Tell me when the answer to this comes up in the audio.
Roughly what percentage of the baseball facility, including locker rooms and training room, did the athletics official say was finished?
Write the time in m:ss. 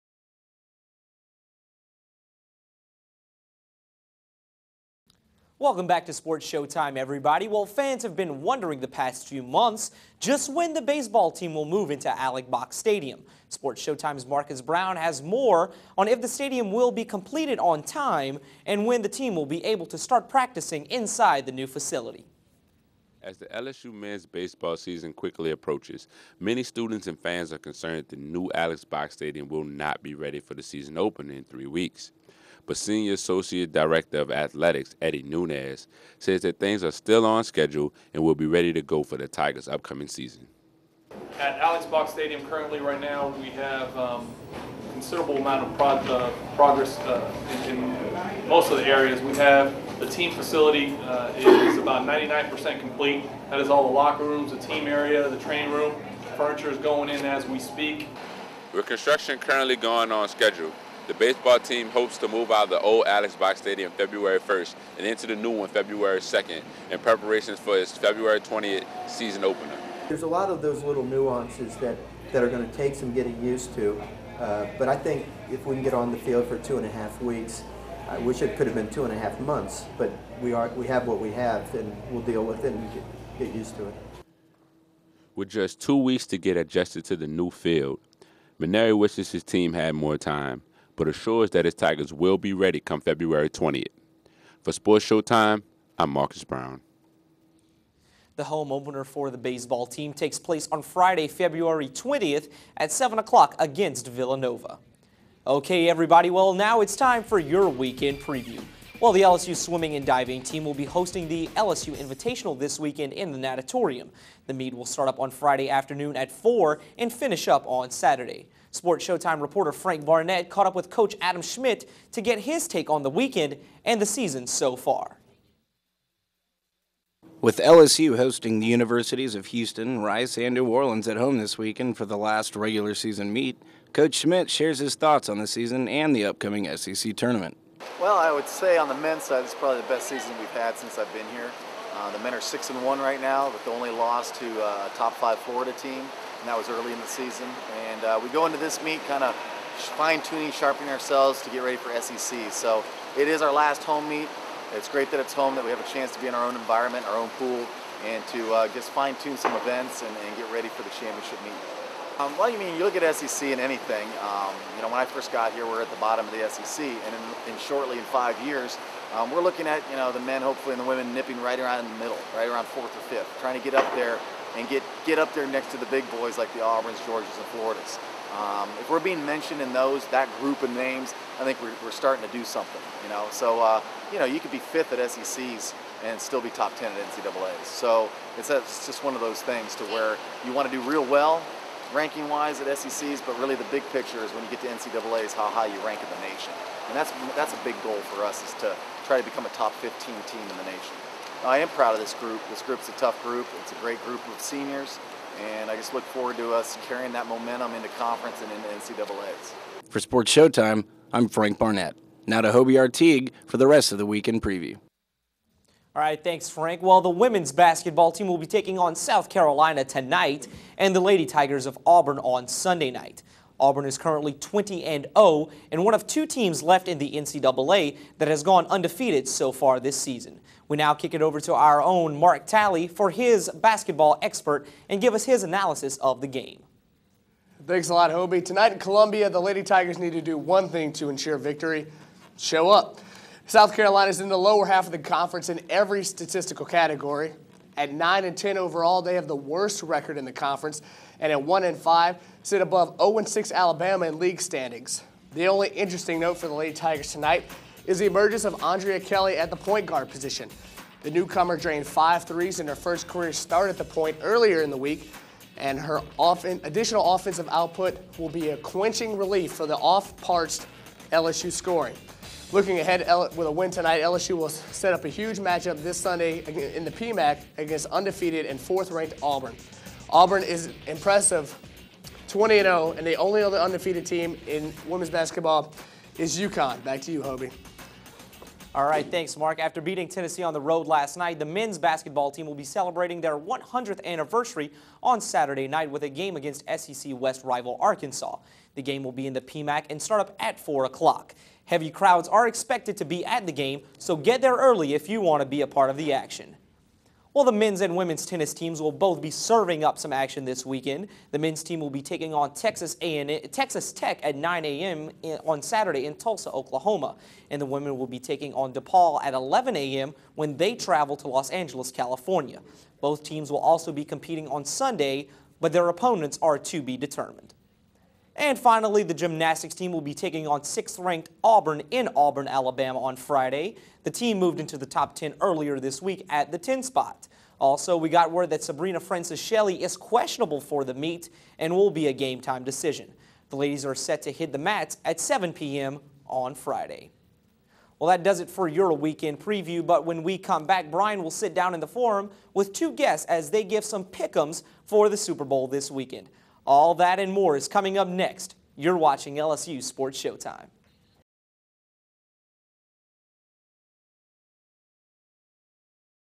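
0:52.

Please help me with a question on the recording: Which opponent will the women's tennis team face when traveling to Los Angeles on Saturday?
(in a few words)
DePaul.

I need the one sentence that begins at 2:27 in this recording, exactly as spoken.
And uh, we go into this meet kind of fine-tuning, sharpening ourselves to get ready for SEC.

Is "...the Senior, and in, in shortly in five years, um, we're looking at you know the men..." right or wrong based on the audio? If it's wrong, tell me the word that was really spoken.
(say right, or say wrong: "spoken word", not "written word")
wrong: "SEC", not "Senior".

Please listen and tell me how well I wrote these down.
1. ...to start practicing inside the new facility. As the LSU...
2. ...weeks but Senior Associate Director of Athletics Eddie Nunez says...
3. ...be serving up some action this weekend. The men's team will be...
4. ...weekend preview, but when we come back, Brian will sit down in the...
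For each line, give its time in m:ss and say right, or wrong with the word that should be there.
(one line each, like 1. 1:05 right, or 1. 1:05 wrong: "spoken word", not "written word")
1. 0:19 right
2. 0:31 right
3. 5:09 right
4. 5:48 right.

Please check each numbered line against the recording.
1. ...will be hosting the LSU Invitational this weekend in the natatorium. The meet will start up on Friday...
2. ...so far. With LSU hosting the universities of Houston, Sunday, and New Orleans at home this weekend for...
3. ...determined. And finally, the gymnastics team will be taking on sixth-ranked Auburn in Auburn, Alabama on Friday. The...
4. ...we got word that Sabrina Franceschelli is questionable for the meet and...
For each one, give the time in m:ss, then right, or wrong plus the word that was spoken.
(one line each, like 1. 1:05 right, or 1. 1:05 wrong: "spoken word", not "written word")
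1. 1:50 right
2. 2:04 wrong: "Rice", not "Sunday"
3. 5:26 right
4. 5:37 right.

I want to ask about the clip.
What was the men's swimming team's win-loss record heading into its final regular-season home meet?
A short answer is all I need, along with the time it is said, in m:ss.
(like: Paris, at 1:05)
6-1, at 2:22.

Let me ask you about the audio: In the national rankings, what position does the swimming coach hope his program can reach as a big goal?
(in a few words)
top 15.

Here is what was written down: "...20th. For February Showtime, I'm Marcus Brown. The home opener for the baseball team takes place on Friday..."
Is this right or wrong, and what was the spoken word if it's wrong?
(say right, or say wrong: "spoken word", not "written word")
wrong: "Sports", not "February".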